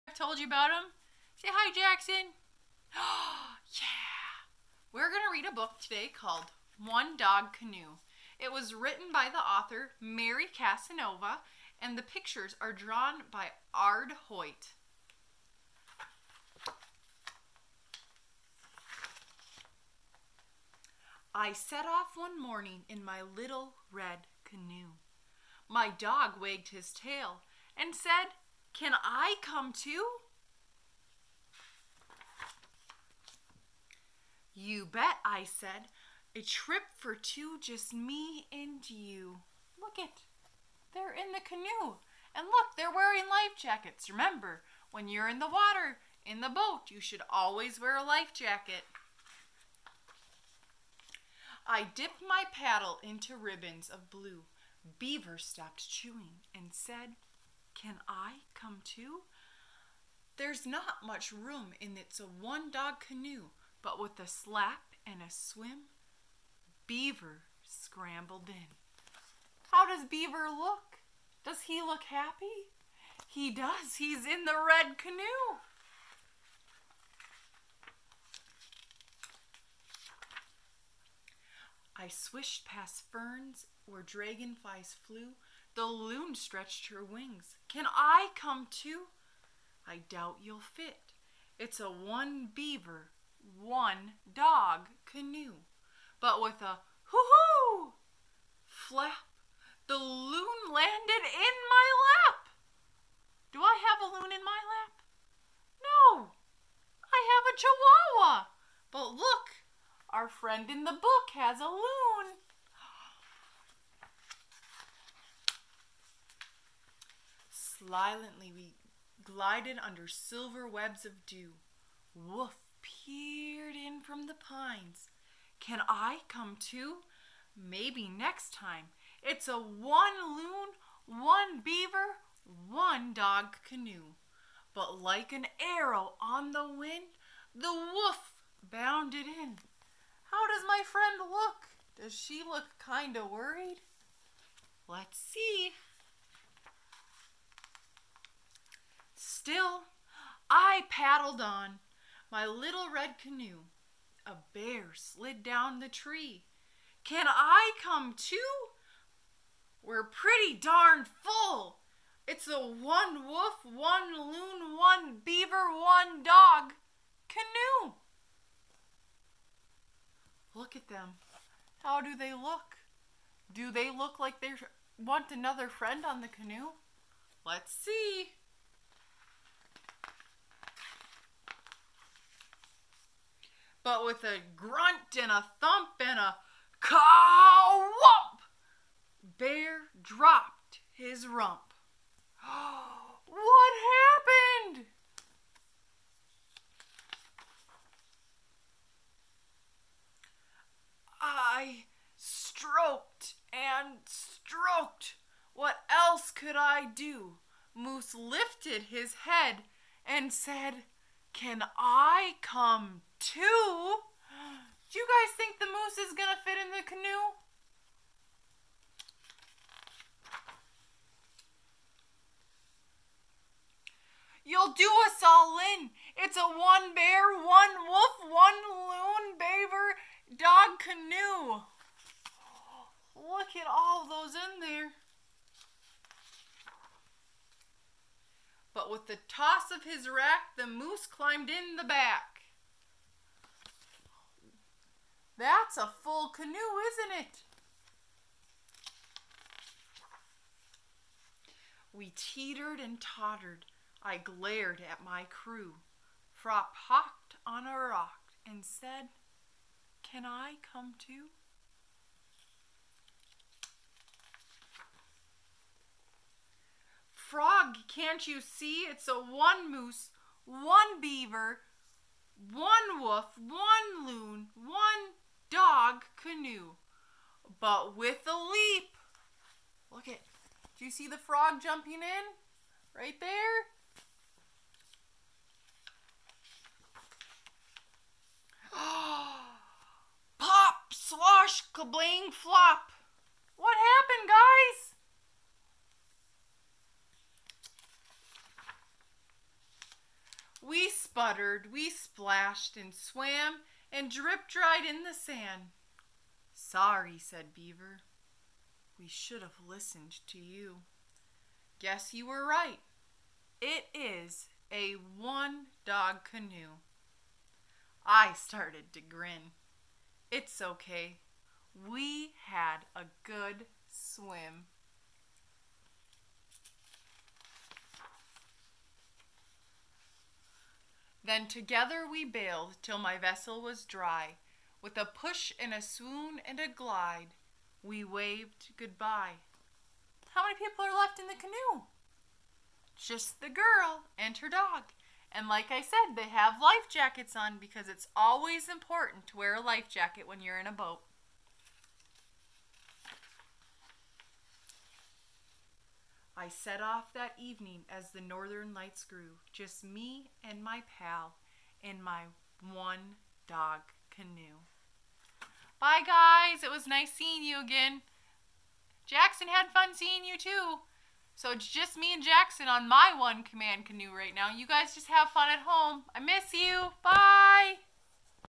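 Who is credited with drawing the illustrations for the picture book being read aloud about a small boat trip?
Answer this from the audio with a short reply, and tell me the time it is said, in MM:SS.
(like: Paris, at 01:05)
Ard Hoyt, at 00:13.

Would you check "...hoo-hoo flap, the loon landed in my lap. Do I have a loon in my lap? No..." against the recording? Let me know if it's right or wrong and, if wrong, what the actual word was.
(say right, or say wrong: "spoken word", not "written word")
right.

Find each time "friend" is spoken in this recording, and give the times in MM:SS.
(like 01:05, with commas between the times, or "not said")
01:50, 02:20, 02:55.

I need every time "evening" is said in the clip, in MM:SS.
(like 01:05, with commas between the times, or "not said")
05:57.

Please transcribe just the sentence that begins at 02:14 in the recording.
But like an arrow on the wind, the wolf bounded in.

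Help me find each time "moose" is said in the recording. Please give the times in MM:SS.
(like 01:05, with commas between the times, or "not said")
03:27, 03:35, 04:00, 04:29.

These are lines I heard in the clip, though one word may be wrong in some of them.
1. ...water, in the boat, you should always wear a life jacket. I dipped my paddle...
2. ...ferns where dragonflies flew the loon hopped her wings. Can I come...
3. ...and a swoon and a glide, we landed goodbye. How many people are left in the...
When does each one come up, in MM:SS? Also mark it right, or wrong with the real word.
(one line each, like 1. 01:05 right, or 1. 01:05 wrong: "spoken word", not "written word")
1. 00:45 right
2. 01:23 wrong: "stretched", not "hopped"
3. 05:35 wrong: "waved", not "landed".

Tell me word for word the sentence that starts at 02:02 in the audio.
Wolf peered in from the pines.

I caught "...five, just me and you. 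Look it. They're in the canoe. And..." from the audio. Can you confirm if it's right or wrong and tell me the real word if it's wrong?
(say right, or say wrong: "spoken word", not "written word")
wrong: "two", not "five".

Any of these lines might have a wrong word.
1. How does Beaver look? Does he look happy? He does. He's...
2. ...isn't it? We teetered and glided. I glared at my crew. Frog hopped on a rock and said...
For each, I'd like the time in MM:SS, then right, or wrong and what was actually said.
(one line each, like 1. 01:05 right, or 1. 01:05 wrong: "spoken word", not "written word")
1. 01:09 right
2. 04:06 wrong: "tottered", not "glided".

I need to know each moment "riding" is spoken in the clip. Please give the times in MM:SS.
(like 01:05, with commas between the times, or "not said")
not said.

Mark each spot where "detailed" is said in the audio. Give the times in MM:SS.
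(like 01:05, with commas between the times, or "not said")
not said.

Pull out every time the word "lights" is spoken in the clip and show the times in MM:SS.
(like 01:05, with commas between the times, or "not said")
05:58.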